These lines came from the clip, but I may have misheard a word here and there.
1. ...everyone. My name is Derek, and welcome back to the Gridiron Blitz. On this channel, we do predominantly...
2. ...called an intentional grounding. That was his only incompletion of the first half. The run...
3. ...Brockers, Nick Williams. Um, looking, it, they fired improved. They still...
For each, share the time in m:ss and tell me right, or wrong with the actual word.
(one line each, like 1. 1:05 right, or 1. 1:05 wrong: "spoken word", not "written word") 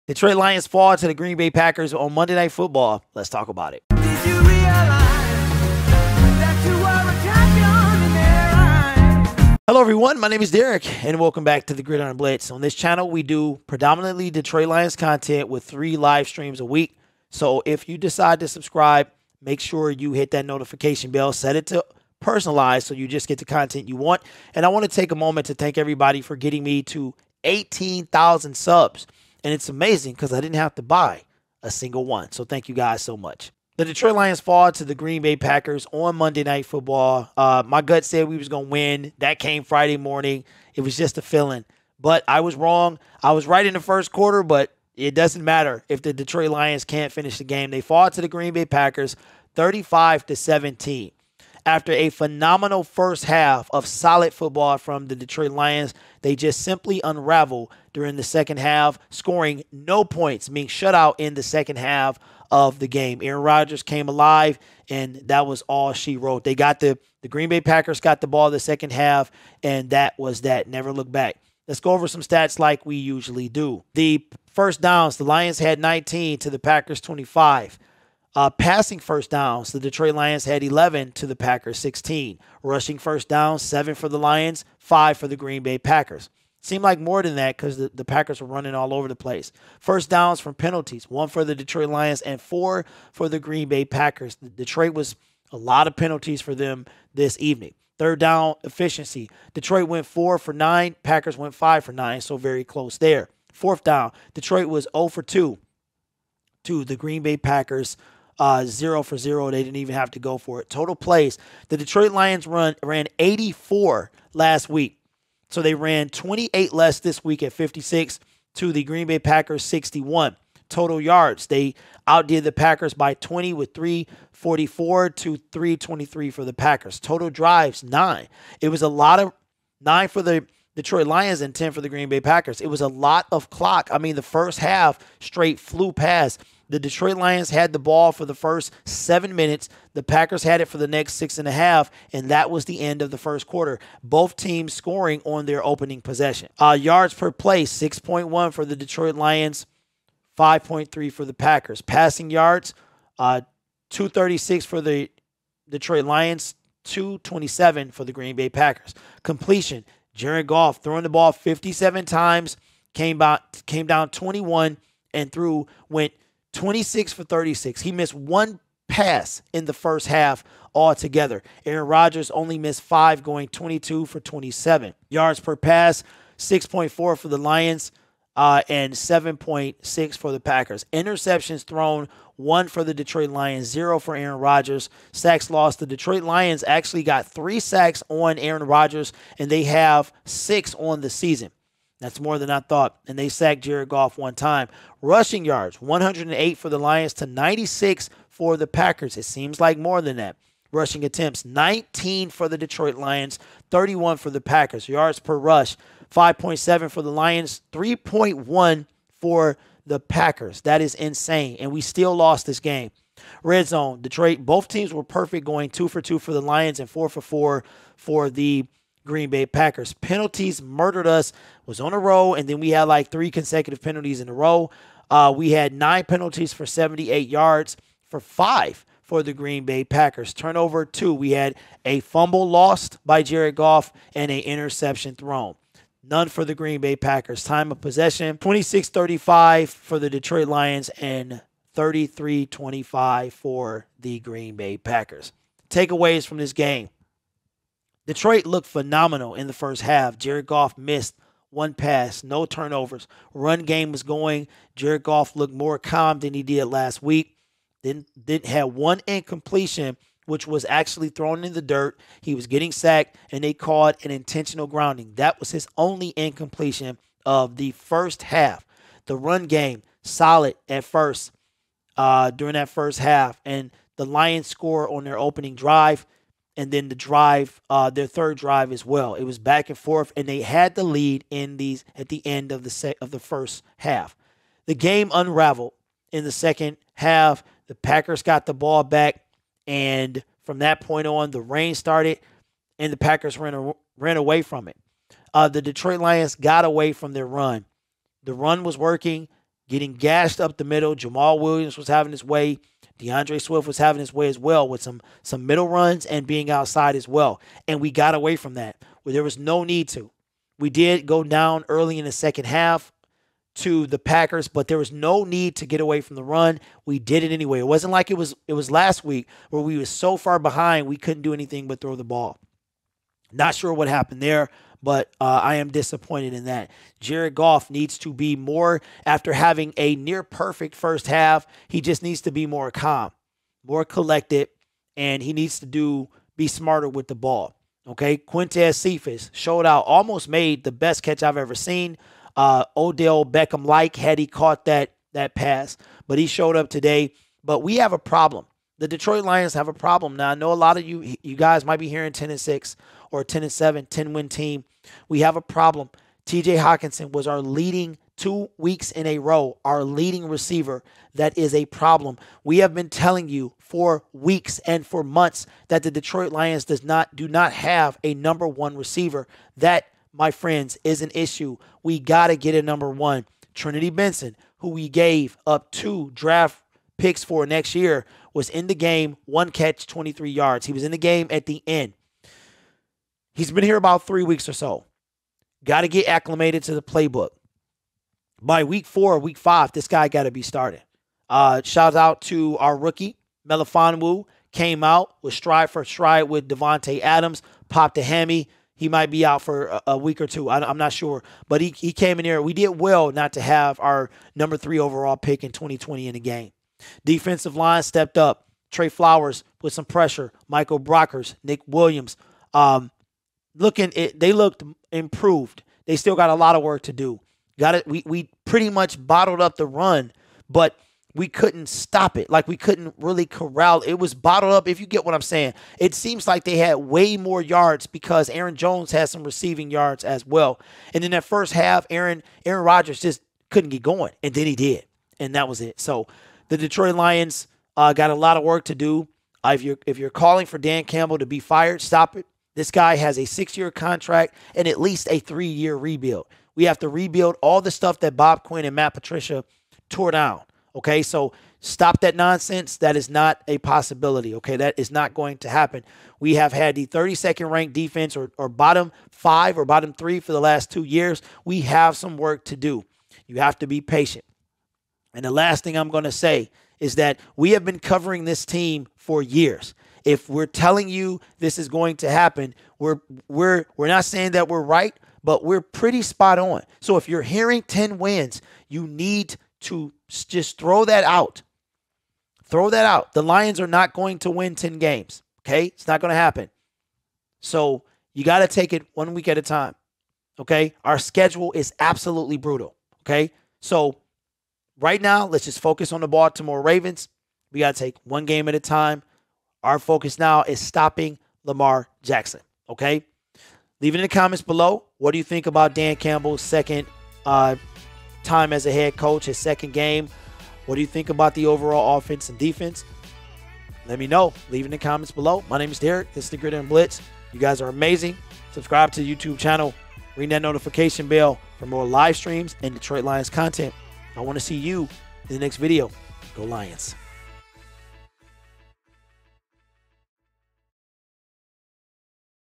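1. 0:09 right
2. 4:23 right
3. 6:50 wrong: "looked", not "fired".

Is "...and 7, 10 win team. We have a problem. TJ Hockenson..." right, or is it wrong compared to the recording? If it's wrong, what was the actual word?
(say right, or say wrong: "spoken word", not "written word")
right.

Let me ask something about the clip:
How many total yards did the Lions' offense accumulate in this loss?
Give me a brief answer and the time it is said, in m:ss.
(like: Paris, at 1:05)
344, at 2:03.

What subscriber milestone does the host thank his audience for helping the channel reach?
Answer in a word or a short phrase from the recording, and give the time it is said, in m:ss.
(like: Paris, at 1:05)
18,000, at 0:27.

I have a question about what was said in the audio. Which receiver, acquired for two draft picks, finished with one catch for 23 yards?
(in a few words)
Trinity Benson.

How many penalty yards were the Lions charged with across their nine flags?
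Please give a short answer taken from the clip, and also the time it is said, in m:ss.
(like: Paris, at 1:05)
78, at 3:46.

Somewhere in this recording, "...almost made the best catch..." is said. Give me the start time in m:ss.
5:39.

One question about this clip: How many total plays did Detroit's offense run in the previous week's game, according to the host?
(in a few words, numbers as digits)
84.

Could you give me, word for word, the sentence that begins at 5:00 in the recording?
Jamaal Williams was having his way.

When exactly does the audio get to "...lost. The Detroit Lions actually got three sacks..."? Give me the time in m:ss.
3:05.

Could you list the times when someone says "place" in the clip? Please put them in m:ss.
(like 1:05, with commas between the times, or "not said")
1:29.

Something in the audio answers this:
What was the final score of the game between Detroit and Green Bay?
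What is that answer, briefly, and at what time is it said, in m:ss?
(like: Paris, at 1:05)
35 to 17, at 0:49.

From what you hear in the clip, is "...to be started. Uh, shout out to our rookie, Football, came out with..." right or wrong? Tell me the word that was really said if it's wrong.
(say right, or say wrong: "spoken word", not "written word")
wrong: "Melifonwu", not "Football".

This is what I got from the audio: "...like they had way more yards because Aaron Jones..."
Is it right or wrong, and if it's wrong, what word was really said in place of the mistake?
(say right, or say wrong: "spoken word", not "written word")
right.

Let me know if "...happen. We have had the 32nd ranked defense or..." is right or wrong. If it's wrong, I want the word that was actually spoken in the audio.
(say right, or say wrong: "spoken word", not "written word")
right.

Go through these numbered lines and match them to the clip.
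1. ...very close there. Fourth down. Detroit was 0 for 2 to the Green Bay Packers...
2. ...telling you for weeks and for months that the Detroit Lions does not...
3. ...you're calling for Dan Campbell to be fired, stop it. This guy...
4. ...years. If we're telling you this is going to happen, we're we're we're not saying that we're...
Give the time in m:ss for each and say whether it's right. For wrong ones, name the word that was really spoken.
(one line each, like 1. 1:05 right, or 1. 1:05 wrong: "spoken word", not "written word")
1. 1:42 right
2. 6:02 right
3. 7:19 right
4. 7:49 right.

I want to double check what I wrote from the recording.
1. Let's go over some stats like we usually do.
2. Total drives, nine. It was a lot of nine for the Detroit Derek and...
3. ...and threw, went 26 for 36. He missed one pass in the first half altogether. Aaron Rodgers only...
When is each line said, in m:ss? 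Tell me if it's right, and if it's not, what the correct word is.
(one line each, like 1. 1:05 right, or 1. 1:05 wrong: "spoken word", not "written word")
1. 1:11 right
2. 2:06 wrong: "Lions", not "Derek"
3. 2:45 right.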